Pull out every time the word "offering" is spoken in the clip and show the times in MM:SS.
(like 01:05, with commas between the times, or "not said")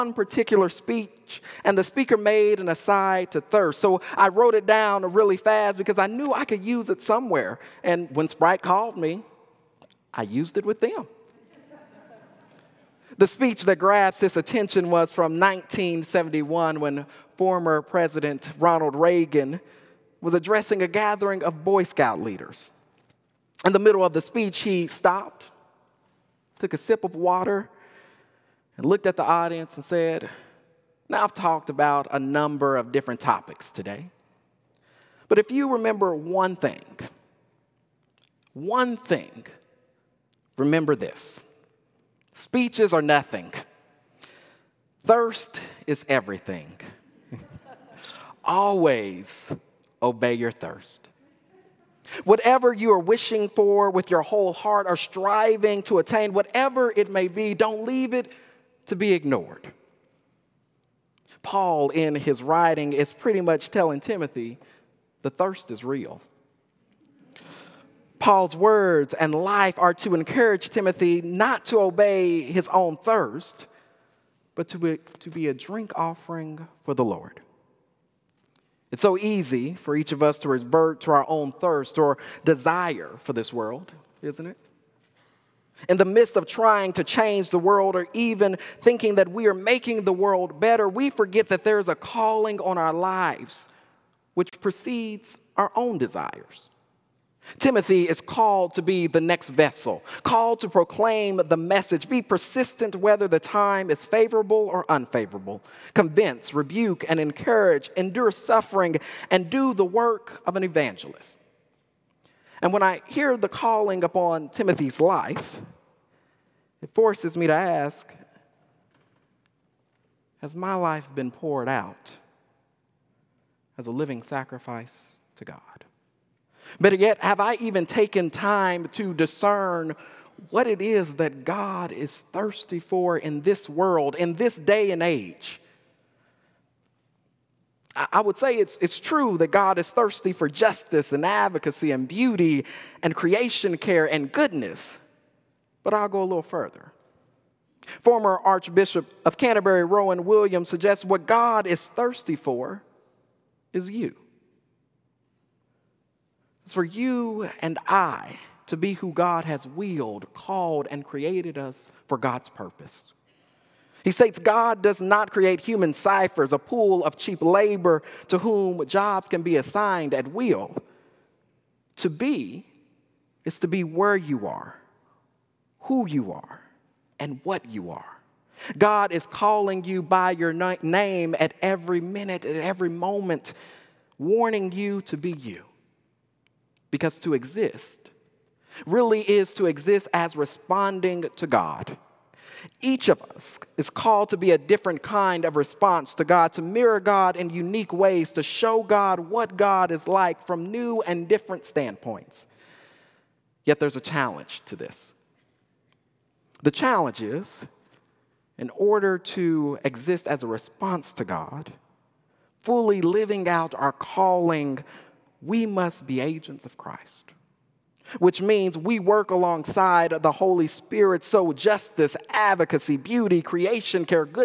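01:15.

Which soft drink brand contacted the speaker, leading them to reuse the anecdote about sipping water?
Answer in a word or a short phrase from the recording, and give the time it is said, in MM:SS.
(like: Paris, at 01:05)
Sprite, at 00:08.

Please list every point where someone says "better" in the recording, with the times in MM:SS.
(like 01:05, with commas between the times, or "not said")
01:30, 02:06.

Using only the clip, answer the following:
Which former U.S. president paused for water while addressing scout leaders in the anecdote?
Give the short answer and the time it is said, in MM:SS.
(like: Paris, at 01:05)
Ronald Reagan, at 00:18.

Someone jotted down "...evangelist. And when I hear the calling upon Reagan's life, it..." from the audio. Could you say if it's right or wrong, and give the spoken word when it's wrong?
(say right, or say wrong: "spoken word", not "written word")
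wrong: "Timothy", not "Reagan".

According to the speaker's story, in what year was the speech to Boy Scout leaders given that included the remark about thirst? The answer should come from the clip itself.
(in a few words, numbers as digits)
1971.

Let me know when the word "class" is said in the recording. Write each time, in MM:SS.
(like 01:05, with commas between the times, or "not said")
not said.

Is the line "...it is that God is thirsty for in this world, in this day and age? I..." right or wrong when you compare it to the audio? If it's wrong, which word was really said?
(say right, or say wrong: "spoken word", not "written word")
right.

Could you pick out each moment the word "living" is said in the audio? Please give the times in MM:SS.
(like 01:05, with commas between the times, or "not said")
02:03, 03:33.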